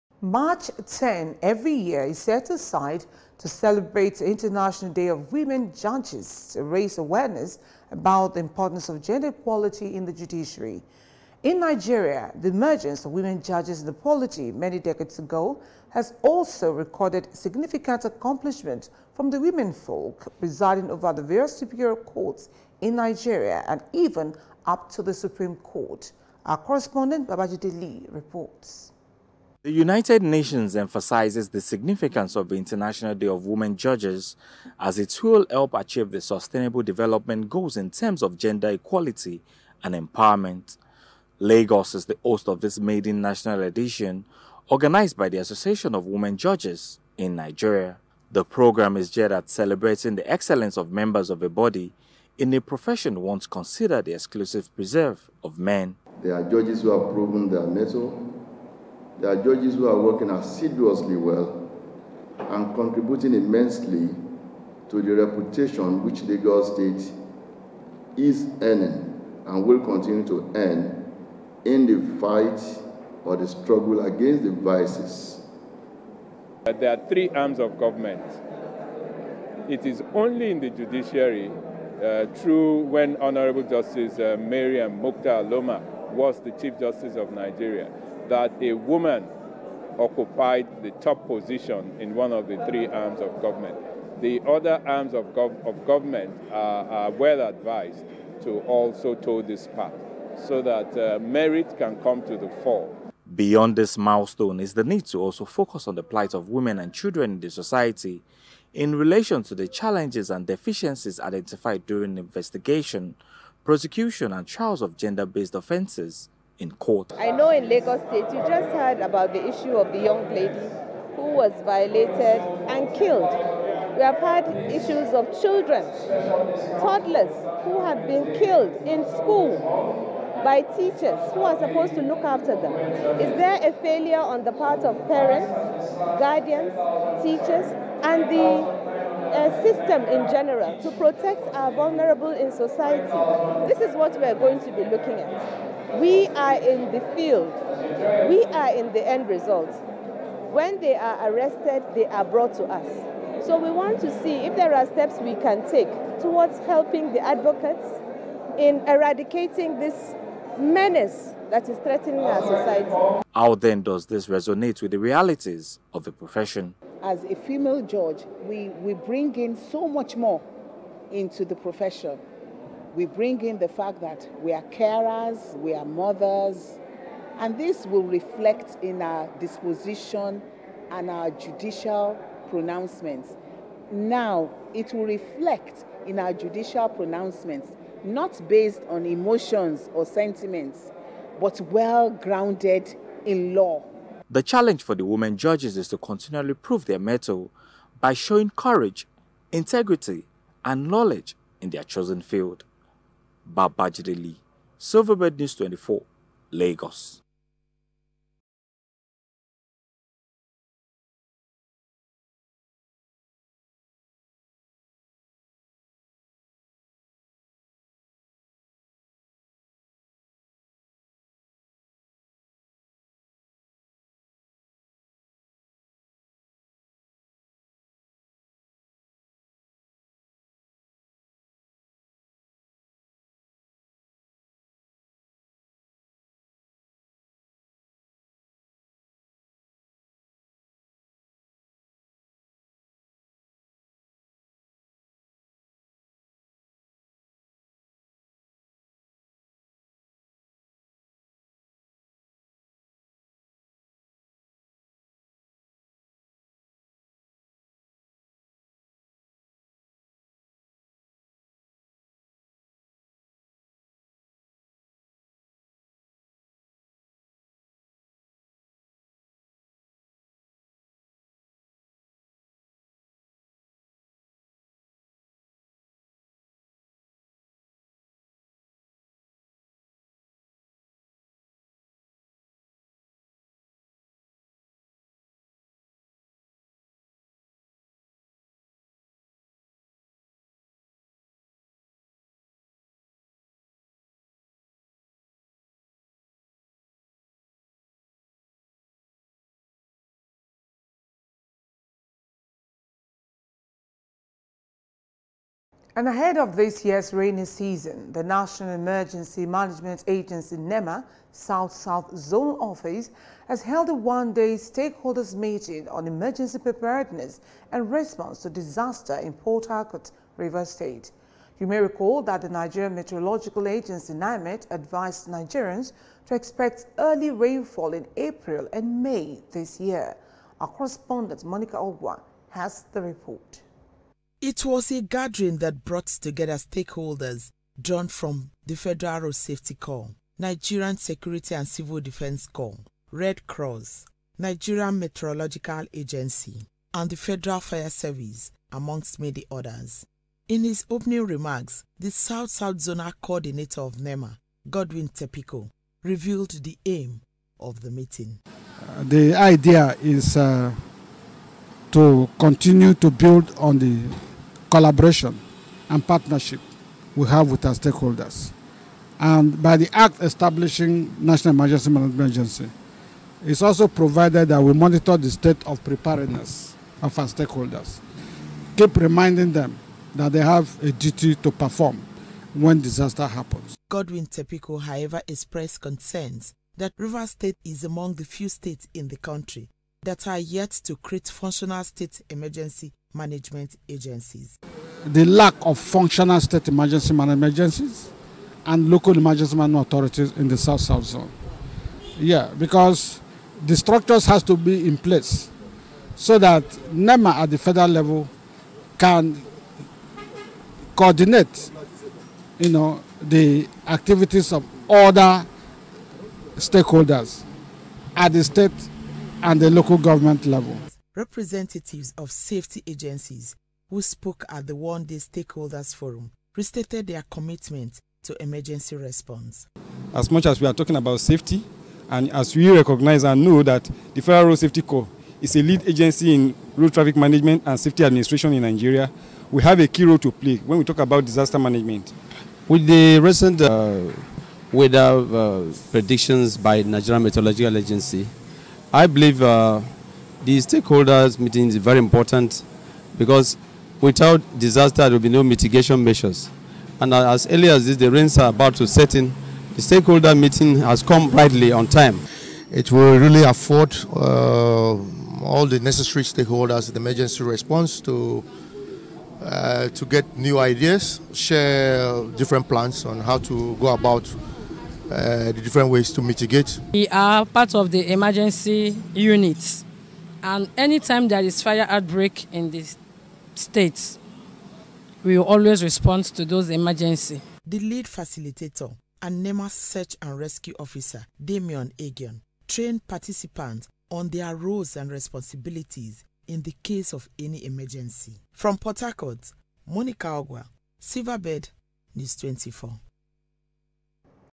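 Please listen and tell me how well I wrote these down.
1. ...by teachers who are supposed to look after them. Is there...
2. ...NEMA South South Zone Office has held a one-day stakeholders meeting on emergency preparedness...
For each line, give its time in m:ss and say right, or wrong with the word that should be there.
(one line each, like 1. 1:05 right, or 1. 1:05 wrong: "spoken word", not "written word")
1. 2:10 right
2. 5:10 right.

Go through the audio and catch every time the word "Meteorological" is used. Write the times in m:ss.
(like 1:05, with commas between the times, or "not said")
5:22, 5:44, 7:27.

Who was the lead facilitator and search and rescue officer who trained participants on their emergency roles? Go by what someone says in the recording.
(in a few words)
Damian Agion.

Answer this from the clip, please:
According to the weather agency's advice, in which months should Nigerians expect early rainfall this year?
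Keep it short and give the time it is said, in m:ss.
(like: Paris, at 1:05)
April and May, at 5:28.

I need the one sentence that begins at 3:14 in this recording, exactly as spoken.
The challenge for the women judges is to continually prove their mettle by showing courage, integrity, and knowledge in their chosen field.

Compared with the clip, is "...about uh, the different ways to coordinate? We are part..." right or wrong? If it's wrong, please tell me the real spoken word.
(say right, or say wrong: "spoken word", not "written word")
wrong: "mitigate", not "coordinate".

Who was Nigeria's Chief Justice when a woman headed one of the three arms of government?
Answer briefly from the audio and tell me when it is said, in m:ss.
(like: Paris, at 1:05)
Mariam Mukhtar Loma, at 1:24.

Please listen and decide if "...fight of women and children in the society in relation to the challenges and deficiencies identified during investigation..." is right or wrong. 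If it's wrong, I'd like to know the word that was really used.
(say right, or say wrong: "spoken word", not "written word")
wrong: "plight", not "fight".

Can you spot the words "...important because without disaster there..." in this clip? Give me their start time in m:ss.
7:31.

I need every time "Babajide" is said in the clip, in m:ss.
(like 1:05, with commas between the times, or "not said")
0:27, 3:23.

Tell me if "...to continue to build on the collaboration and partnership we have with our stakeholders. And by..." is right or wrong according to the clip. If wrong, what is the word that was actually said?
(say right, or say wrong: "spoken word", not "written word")
right.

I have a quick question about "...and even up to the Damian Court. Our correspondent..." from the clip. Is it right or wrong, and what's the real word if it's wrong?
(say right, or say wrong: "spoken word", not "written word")
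wrong: "Supreme", not "Damian".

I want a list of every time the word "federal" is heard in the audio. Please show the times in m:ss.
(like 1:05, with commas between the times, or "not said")
5:38, 5:47, 6:47, 7:14.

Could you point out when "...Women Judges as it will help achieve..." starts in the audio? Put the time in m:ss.
0:33.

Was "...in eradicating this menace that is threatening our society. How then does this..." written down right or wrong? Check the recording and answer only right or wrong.
right.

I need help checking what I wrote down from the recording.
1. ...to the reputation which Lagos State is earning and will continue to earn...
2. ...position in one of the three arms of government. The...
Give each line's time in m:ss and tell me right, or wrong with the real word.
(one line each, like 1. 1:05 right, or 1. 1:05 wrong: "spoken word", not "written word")
1. 1:04 right
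2. 1:31 right.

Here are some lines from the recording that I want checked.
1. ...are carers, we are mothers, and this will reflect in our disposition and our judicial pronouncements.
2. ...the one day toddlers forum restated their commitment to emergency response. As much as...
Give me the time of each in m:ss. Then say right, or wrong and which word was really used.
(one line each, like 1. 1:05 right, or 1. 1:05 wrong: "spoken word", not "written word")
1. 2:54 right
2. 7:04 wrong: "stakeholders", not "toddlers".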